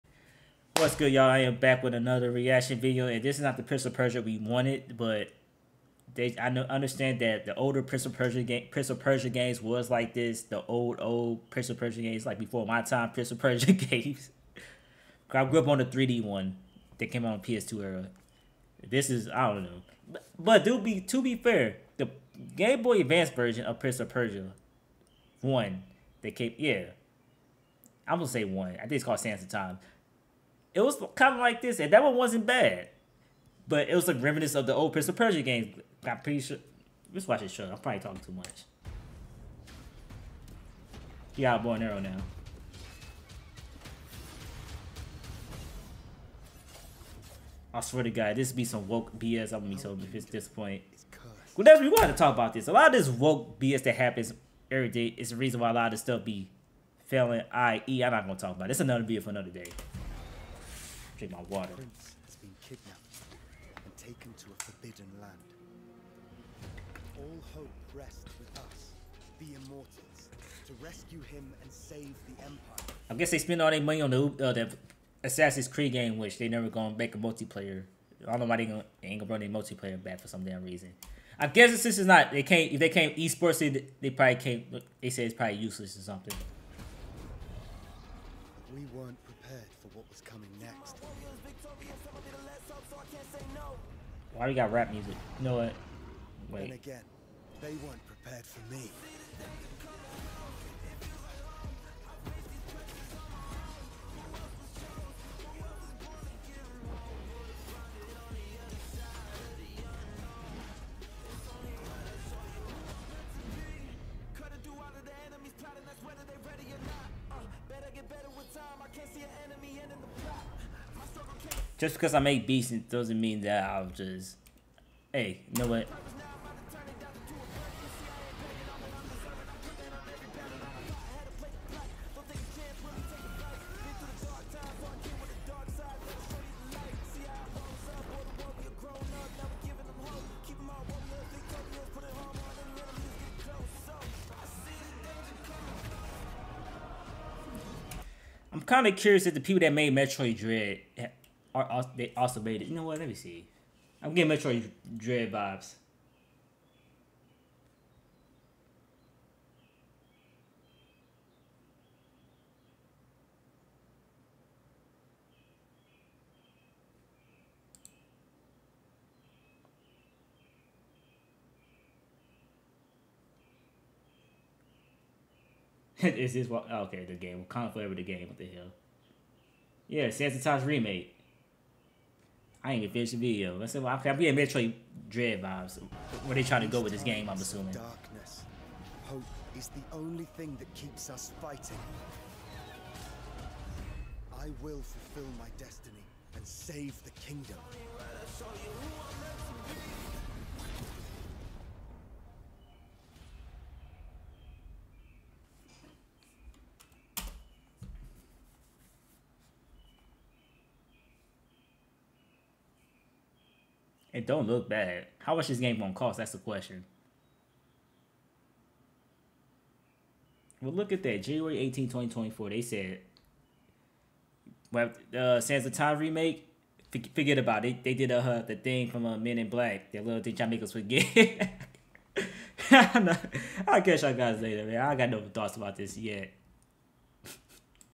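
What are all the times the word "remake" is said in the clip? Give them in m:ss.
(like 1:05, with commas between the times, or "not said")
3:00, 3:45.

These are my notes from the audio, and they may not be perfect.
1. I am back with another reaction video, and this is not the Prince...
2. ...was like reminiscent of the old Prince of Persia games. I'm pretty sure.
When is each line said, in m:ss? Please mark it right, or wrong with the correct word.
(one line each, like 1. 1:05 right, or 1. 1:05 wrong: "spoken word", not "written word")
1. 0:01 right
2. 0:33 right.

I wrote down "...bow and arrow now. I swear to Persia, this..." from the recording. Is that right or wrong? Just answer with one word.
wrong.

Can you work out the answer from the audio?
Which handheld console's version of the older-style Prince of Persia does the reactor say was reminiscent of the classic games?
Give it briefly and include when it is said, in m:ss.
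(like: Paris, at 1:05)
Game Boy Advance, at 0:22.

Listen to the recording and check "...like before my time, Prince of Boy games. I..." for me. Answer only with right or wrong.
wrong.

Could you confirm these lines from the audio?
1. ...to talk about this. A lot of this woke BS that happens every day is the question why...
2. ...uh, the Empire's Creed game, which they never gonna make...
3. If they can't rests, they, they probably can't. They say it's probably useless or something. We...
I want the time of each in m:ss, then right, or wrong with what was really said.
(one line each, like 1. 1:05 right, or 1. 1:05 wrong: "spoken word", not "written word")
1. 0:52 wrong: "reason", not "question"
2. 1:14 wrong: "Assassin", not "Empire"
3. 1:22 wrong: "esports", not "rests".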